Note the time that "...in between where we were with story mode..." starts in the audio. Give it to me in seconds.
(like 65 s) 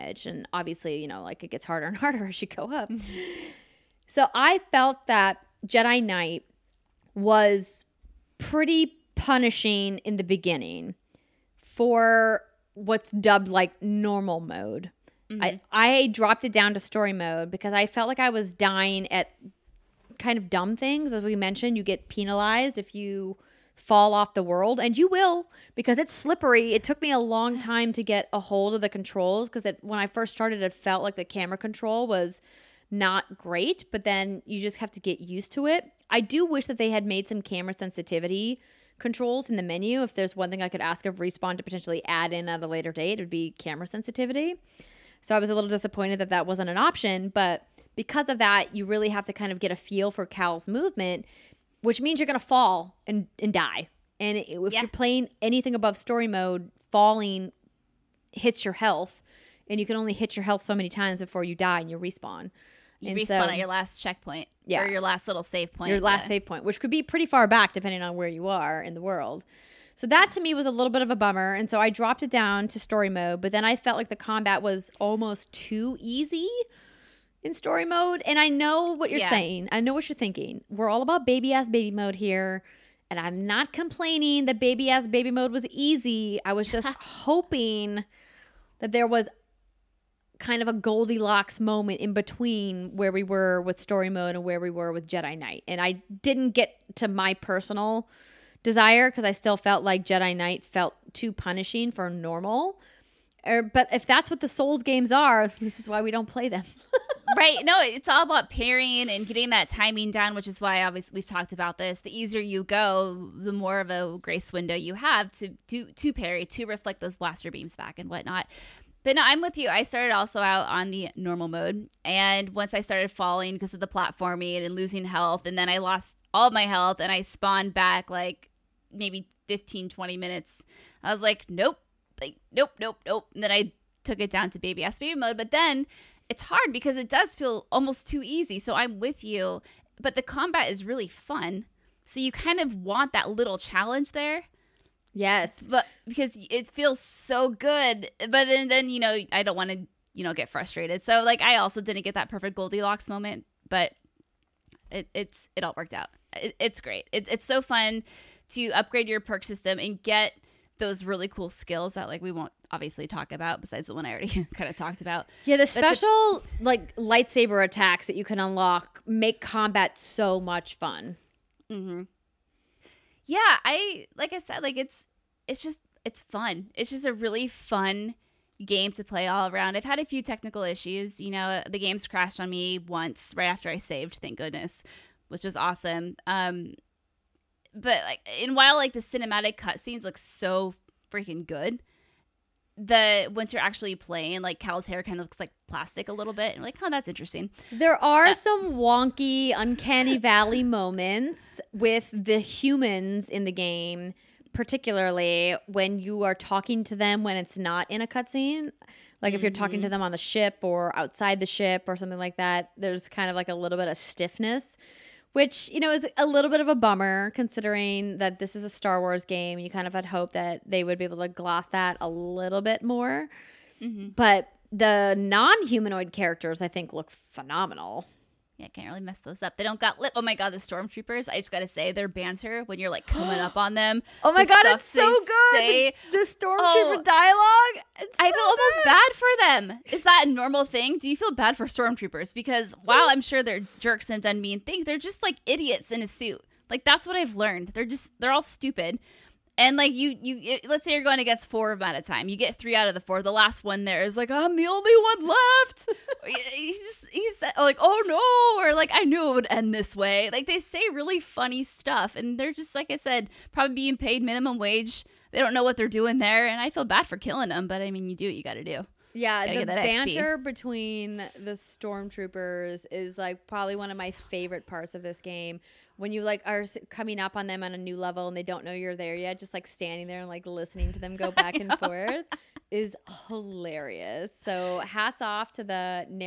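92 s.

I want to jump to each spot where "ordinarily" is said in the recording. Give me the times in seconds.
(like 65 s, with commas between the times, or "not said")
not said.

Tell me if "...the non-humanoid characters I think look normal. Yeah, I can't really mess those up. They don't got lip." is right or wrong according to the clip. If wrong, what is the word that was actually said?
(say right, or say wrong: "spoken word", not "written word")
wrong: "phenomenal", not "normal".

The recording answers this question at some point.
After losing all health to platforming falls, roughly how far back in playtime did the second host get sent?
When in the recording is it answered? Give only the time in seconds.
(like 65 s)
129 s.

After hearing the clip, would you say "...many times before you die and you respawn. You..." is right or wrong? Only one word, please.
right.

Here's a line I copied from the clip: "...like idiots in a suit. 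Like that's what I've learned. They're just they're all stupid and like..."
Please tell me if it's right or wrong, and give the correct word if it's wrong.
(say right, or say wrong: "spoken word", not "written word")
right.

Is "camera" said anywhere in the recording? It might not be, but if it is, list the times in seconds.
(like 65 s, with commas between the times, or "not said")
31 s, 37 s, 43 s.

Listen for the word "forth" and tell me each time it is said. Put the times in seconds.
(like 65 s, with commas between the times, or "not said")
281 s.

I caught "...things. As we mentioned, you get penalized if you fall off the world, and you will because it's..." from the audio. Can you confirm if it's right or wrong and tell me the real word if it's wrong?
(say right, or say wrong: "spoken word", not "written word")
right.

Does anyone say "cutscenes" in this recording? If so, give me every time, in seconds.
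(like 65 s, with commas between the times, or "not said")
189 s, 208 s.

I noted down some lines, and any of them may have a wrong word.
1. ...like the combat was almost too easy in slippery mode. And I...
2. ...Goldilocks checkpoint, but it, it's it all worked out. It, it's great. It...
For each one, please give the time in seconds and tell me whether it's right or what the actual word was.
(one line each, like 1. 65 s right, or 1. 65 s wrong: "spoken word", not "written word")
1. 73 s wrong: "story", not "slippery"
2. 152 s wrong: "moment", not "checkpoint".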